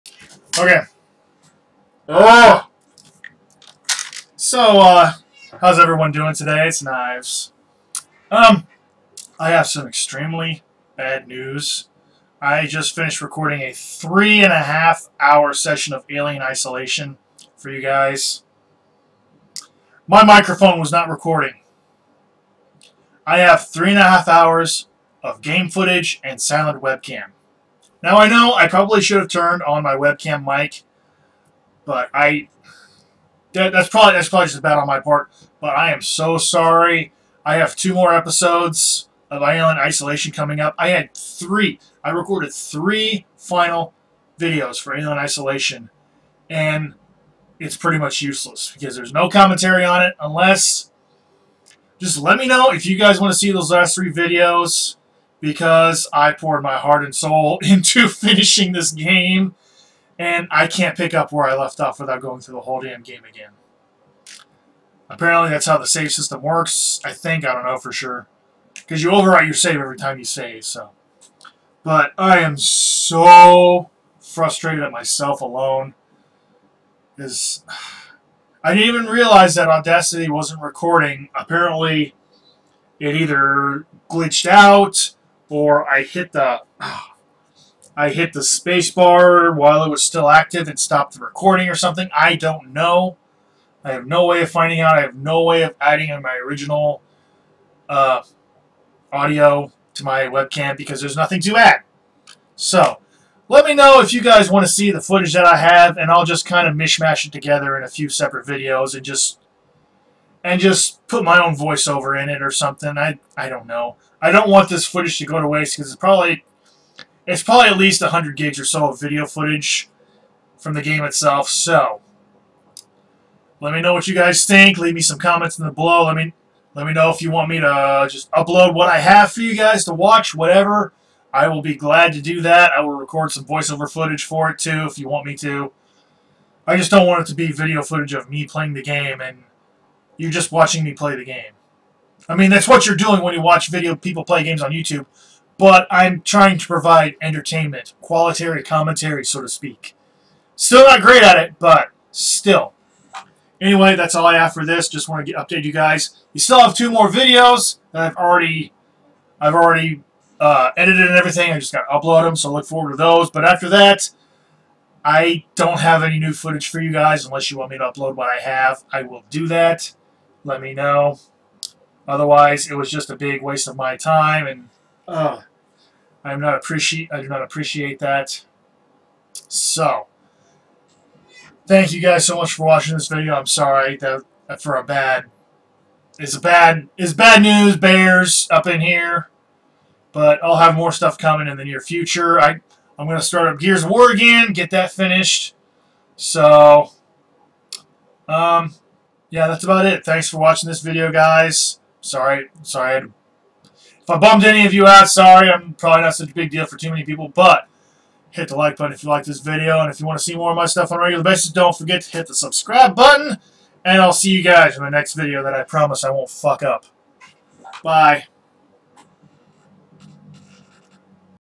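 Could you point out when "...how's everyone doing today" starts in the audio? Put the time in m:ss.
0:05.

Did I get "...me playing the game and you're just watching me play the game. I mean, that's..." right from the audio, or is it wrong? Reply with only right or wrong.
right.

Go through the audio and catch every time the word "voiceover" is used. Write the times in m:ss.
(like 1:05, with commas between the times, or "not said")
1:51, 2:13.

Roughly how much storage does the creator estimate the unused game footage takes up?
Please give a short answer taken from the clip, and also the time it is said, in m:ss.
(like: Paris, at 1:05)
100 gigs, at 1:58.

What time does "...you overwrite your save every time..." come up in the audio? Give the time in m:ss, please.
1:09.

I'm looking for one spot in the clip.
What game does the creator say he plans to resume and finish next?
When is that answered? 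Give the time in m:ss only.
3:13.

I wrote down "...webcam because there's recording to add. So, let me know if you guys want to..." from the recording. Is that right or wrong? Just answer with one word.
wrong.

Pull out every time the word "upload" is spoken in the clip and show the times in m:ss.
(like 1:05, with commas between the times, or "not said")
2:08, 2:41, 2:47.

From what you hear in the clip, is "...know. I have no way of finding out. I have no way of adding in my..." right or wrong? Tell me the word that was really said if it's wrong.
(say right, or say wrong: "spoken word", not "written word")
right.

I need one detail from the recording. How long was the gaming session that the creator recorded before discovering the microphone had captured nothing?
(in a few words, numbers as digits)
3.5 hours.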